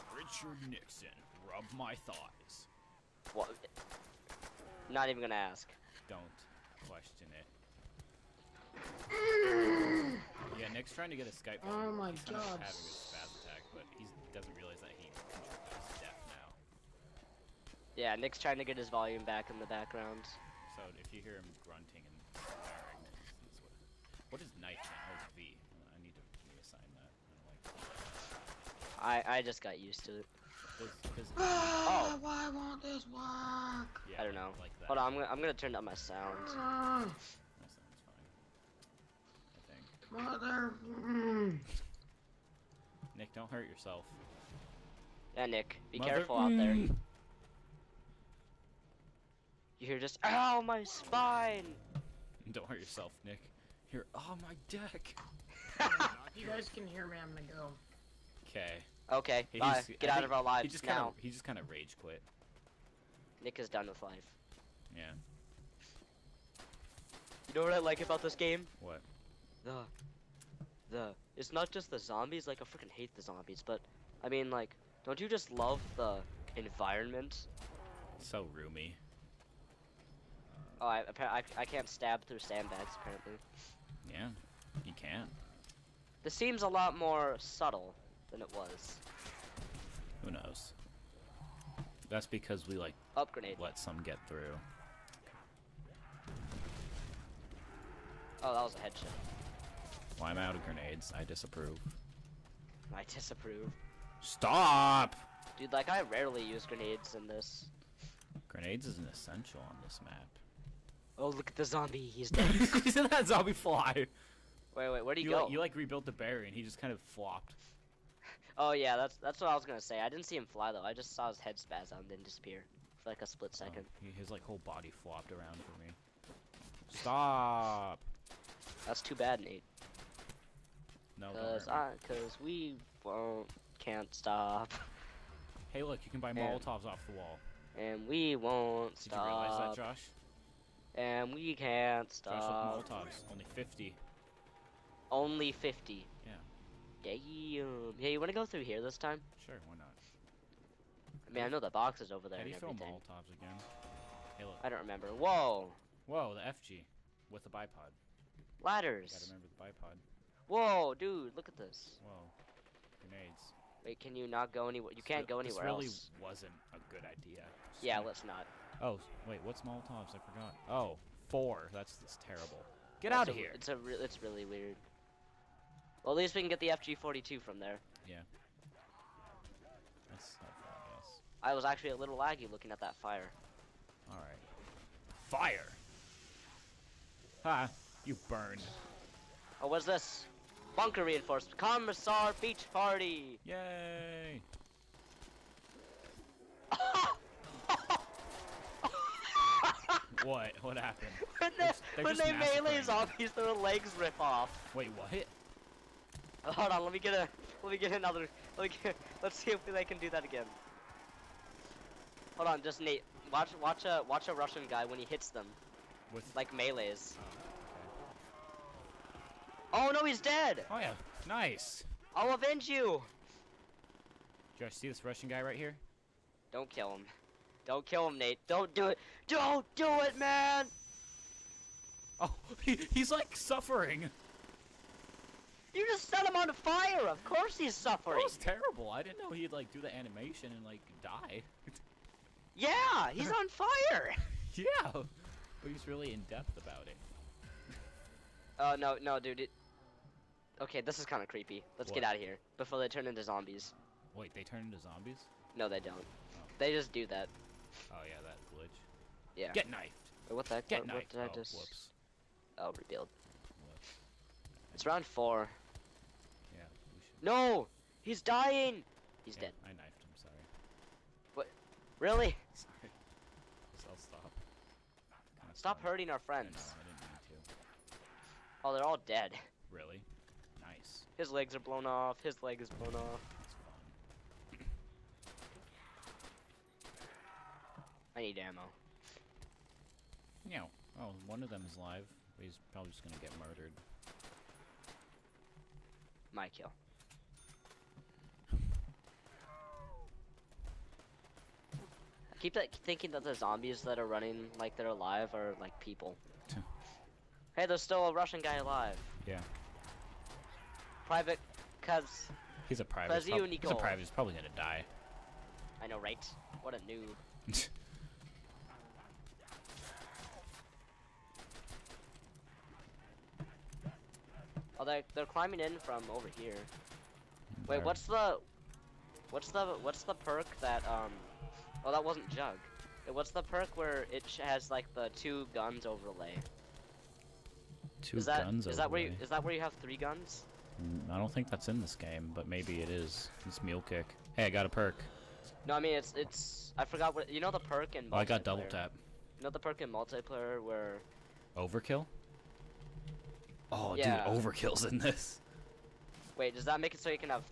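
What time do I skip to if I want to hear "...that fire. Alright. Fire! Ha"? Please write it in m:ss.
3:02.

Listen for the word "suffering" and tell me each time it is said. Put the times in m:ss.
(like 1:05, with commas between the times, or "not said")
3:53, 3:57.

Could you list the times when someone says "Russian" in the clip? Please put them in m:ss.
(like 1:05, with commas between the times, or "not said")
3:34, 3:45, 5:08.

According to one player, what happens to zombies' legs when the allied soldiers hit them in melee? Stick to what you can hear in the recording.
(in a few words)
their legs rip off.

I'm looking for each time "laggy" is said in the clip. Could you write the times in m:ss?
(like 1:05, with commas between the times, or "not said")
3:02.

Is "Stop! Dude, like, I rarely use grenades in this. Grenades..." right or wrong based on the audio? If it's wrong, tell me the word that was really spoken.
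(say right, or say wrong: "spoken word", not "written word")
right.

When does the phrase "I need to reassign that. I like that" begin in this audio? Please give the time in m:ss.
0:25.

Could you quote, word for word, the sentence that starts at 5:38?
Two is that, guns is overlay.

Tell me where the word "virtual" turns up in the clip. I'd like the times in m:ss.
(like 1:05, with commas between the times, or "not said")
not said.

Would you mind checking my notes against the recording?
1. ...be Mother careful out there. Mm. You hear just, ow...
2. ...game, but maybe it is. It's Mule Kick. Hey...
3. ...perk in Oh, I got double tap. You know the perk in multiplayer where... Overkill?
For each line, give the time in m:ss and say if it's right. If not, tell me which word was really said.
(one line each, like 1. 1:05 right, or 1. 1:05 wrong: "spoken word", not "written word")
1. 0:45 right
2. 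5:41 right
3. 5:47 right.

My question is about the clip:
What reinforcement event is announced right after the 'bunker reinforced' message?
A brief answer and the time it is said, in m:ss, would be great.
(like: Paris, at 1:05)
Commissar Beach Party, at 3:11.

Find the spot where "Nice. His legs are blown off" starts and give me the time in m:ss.
4:40.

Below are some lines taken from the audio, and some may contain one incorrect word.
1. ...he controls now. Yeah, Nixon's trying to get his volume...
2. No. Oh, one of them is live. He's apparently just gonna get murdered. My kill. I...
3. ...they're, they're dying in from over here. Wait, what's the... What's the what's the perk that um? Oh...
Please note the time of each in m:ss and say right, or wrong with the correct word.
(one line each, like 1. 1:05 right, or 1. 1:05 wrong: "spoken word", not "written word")
1. 0:14 wrong: "Nick", not "Nixon"
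2. 4:50 wrong: "probably", not "apparently"
3. 5:24 wrong: "climbing", not "dying".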